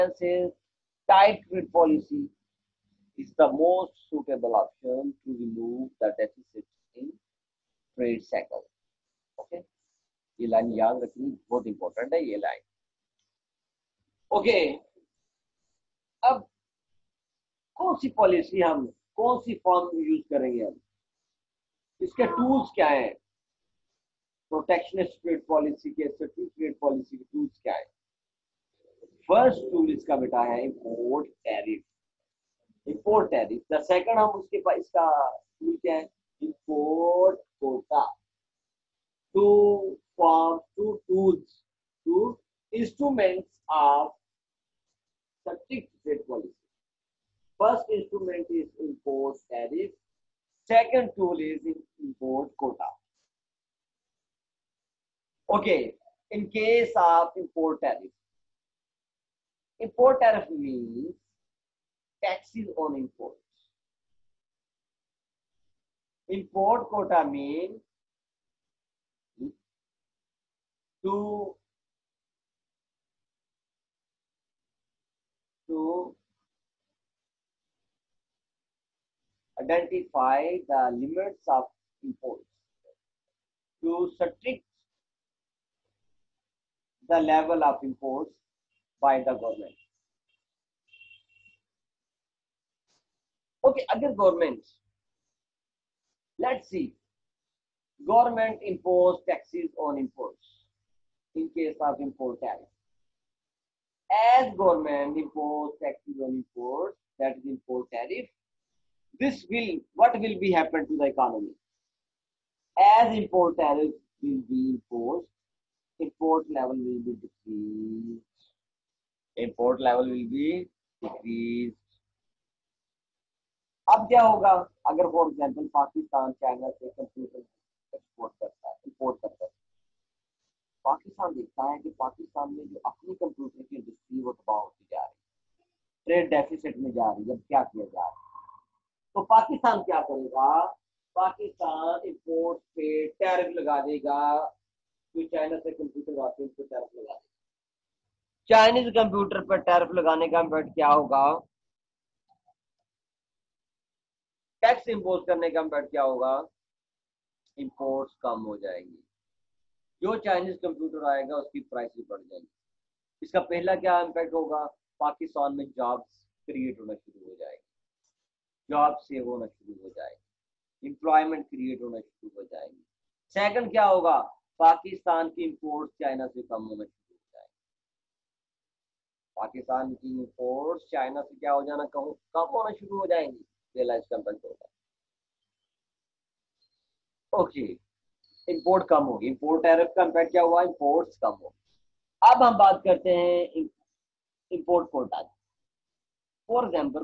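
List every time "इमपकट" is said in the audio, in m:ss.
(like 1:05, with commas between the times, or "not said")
2:30, 2:35, 2:44, 3:10.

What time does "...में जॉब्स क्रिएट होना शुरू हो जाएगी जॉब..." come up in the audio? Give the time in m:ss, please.
2:45.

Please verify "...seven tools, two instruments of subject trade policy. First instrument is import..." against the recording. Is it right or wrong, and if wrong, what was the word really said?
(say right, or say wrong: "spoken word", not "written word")
wrong: "two", not "seven".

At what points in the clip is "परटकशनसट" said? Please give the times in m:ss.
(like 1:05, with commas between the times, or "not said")
0:24.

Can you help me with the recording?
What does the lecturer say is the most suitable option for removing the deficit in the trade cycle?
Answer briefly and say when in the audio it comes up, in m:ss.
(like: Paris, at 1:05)
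Tight trade policy, at 0:01.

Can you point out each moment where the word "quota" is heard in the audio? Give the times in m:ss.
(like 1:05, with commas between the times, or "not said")
0:52, 1:06.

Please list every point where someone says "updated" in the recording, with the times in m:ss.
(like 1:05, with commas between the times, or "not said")
not said.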